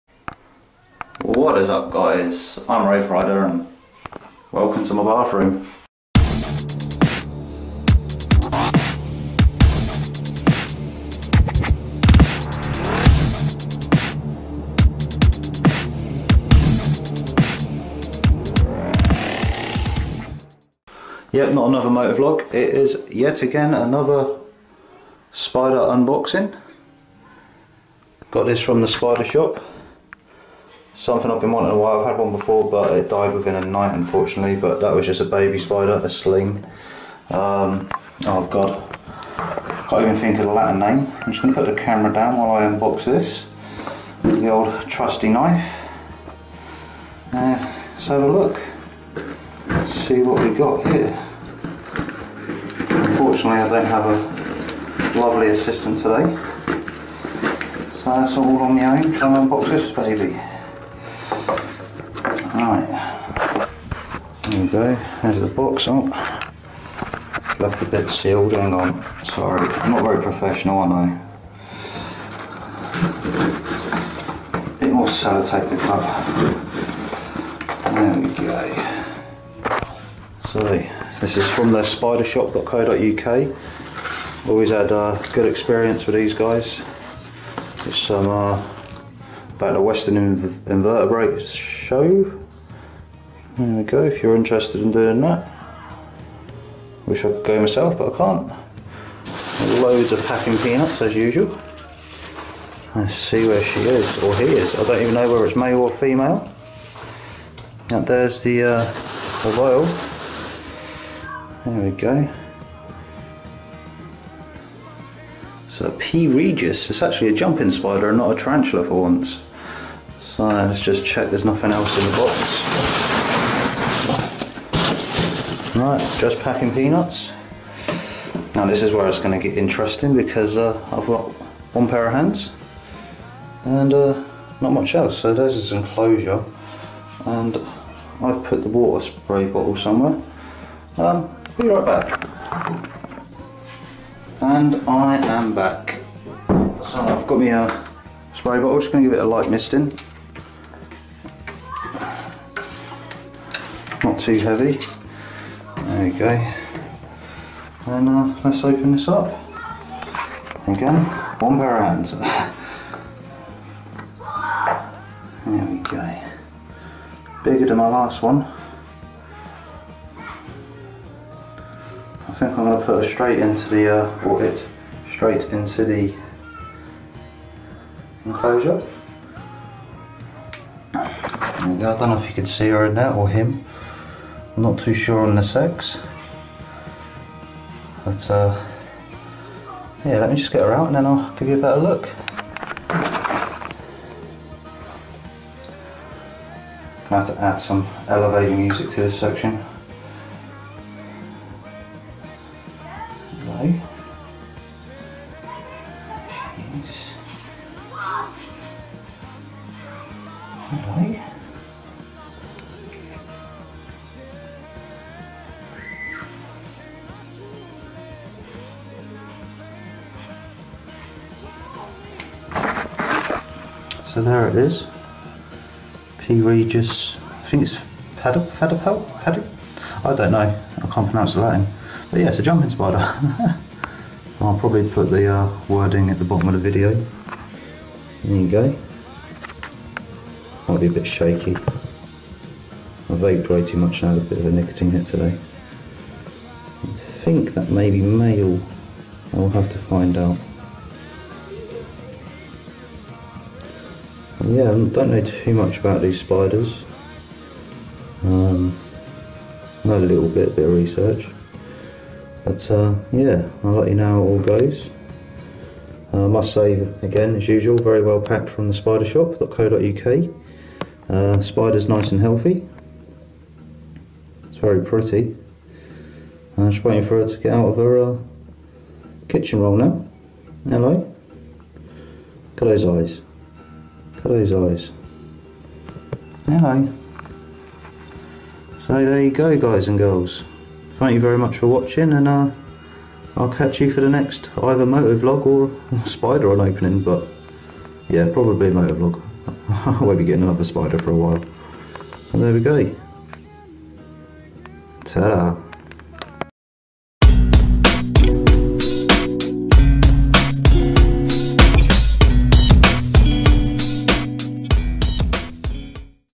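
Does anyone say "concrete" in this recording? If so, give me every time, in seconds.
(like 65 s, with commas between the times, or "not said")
not said.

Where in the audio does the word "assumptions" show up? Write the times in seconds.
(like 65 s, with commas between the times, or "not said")
not said.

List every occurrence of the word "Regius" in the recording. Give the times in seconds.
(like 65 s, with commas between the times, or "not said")
116 s, 226 s.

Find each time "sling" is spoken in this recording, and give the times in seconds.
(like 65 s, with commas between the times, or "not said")
36 s.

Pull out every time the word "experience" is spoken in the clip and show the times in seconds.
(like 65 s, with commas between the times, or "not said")
85 s.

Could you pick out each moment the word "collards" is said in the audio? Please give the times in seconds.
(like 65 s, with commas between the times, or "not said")
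not said.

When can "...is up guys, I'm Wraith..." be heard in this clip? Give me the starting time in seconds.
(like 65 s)
1 s.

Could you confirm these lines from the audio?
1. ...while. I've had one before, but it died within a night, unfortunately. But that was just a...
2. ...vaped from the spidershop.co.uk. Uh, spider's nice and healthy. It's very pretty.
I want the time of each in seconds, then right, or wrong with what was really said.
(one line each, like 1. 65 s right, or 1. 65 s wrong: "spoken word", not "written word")
1. 31 s right
2. 268 s wrong: "packed", not "vaped".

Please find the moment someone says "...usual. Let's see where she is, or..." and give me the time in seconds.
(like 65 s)
101 s.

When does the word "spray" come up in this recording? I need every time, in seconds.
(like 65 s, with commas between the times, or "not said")
139 s, 148 s.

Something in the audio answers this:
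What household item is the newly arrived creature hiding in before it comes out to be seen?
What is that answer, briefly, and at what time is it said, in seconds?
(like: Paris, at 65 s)
Kitchen roll, at 279 s.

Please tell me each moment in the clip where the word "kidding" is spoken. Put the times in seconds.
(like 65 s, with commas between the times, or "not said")
not said.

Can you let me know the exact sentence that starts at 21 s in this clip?
Yep, not another motor vlog, it is yet again another spider unboxing.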